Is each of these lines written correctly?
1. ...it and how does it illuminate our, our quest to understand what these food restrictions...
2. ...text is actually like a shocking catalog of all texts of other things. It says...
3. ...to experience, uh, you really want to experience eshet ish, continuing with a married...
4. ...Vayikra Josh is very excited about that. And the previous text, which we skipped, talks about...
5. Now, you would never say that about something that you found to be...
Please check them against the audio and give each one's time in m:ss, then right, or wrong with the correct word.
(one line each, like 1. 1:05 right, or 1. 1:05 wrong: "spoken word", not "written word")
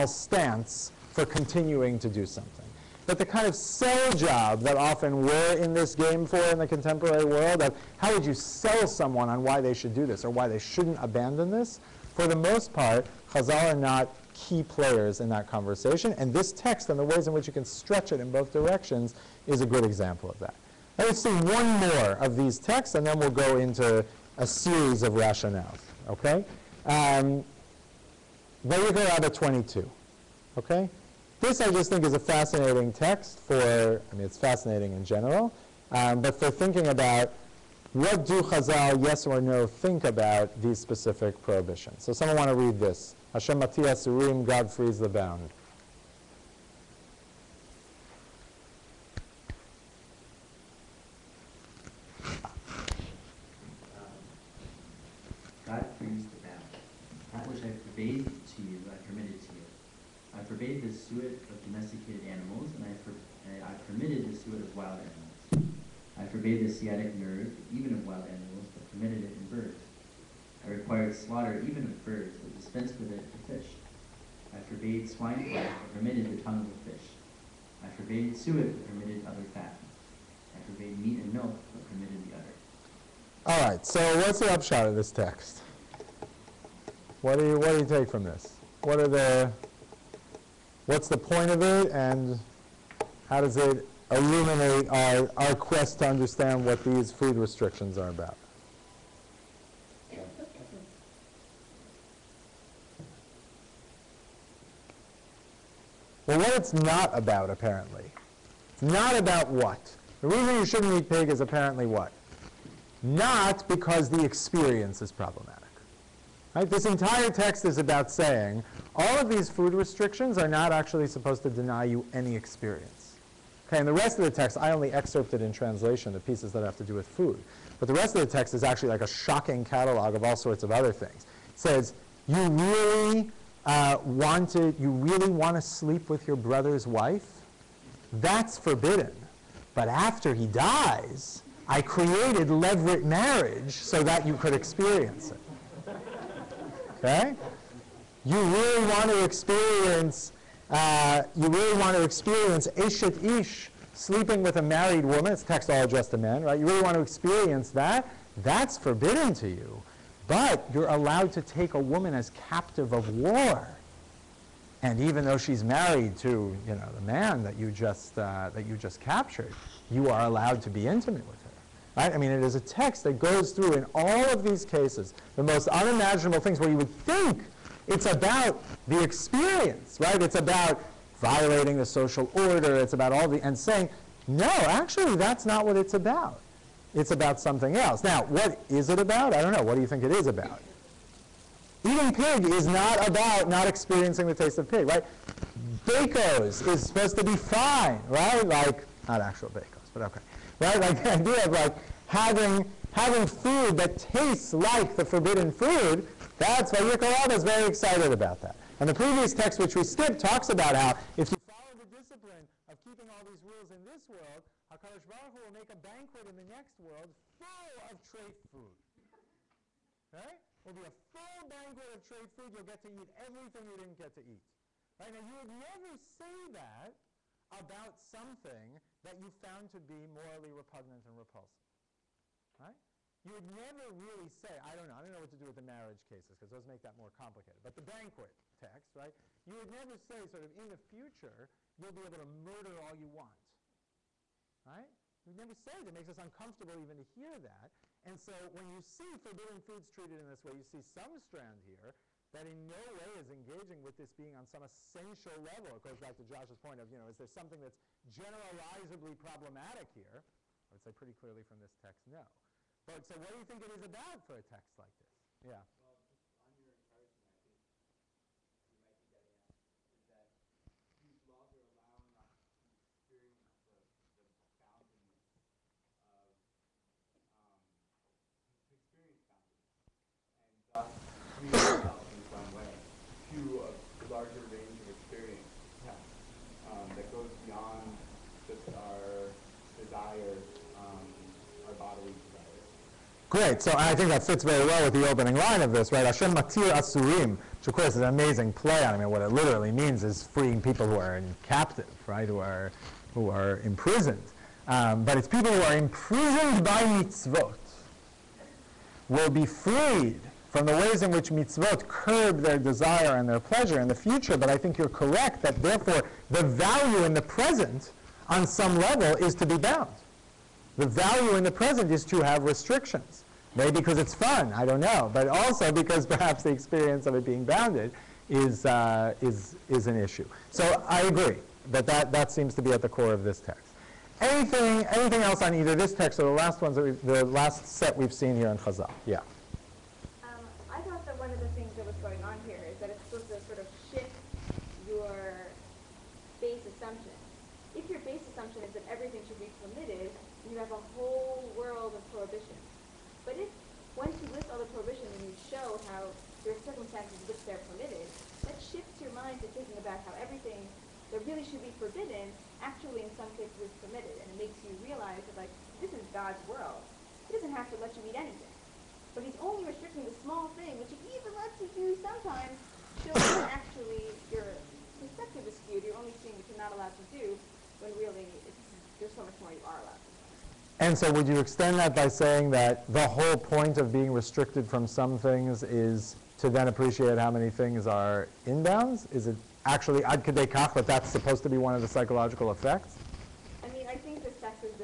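1. 1:31 right
2. 2:08 wrong: "sorts", not "texts"
3. 2:29 wrong: "sleeping", not "continuing"
4. 3:26 wrong: "Rabbah", not "Josh"
5. 3:45 right.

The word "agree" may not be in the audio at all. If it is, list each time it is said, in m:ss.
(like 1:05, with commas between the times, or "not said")
5:31.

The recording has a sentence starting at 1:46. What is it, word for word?
Well, what it's not about, apparently.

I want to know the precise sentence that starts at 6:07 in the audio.
He doesn't have to let you eat anything.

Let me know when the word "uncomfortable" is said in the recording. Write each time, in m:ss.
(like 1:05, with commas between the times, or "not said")
4:06.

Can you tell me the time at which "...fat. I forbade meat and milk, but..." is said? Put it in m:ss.
1:19.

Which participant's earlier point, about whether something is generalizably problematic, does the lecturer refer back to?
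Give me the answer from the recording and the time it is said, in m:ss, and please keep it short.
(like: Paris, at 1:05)
Josh, at 4:16.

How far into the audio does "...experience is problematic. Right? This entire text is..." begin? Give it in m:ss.
1:54.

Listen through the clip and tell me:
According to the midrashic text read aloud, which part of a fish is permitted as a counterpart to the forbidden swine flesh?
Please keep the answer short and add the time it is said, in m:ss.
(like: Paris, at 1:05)
the tongue, at 1:16.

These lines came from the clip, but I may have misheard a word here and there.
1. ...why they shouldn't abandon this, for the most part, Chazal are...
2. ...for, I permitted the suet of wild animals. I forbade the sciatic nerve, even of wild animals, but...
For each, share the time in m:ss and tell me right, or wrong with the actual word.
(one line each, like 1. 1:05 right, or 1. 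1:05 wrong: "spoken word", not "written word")
1. 0:10 right
2. 1:03 right.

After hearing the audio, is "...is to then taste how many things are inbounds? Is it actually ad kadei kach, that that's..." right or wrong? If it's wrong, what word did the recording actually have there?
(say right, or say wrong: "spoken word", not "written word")
wrong: "appreciate", not "taste".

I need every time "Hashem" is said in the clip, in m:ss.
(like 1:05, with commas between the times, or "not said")
0:43, 4:56.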